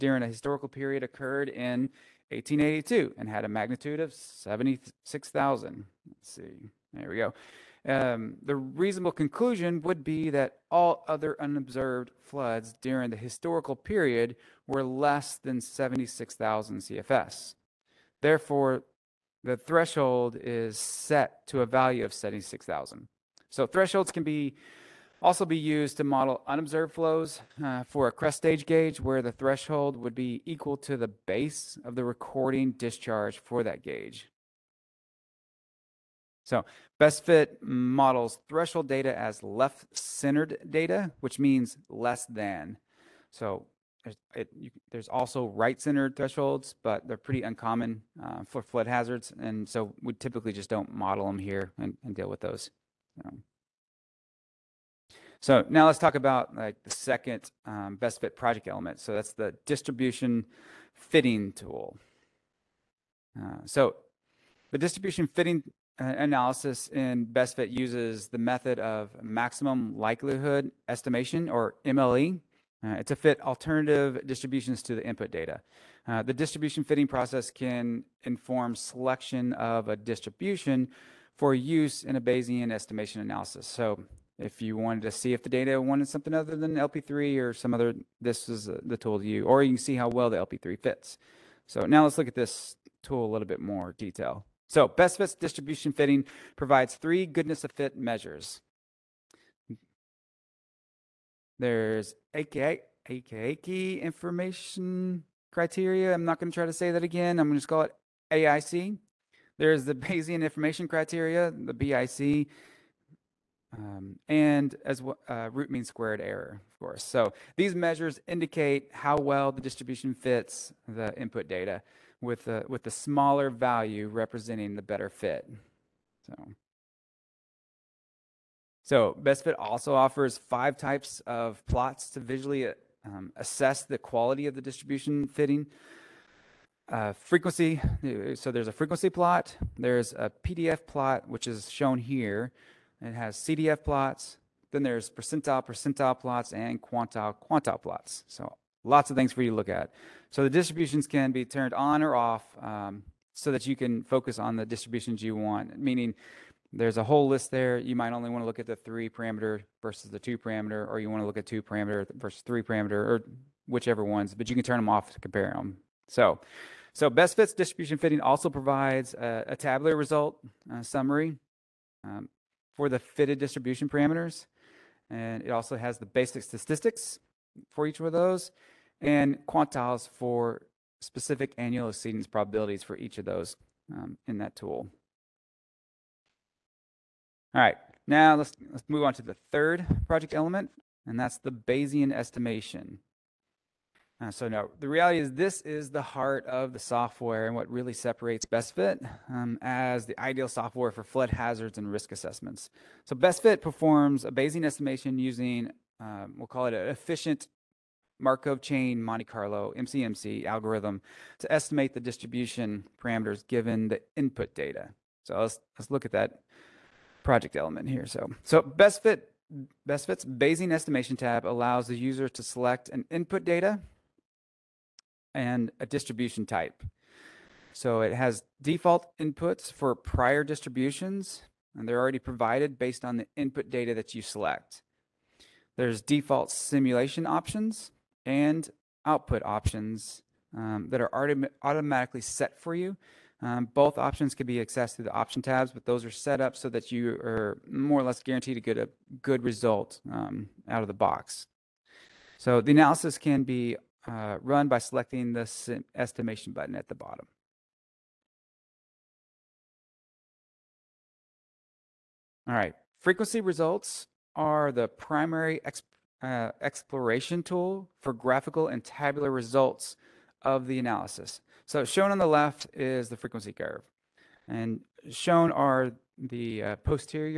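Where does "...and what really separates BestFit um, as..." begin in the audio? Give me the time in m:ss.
3:17.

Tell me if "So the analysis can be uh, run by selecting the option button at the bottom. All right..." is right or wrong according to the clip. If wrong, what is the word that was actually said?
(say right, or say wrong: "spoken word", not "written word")
wrong: "estimation", not "option".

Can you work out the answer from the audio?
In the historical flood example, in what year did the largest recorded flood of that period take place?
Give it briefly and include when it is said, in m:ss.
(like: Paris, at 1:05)
1882, at 0:02.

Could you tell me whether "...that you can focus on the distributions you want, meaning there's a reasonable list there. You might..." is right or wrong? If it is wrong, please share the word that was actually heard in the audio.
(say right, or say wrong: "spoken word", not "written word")
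wrong: "whole", not "reasonable".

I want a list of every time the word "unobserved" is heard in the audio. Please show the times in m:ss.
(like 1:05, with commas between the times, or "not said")
0:11, 0:26.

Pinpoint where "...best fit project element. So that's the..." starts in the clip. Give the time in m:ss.
0:57.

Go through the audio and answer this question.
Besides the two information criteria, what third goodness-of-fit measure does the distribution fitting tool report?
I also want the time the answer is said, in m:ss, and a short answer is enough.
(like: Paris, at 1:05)
Root mean squared error, at 1:55.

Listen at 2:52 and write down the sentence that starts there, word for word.
Um, for the fitted distribution parameters.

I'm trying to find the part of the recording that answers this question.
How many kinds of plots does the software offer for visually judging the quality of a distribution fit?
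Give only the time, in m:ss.
2:10.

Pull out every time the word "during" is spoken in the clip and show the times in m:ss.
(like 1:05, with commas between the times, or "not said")
0:12.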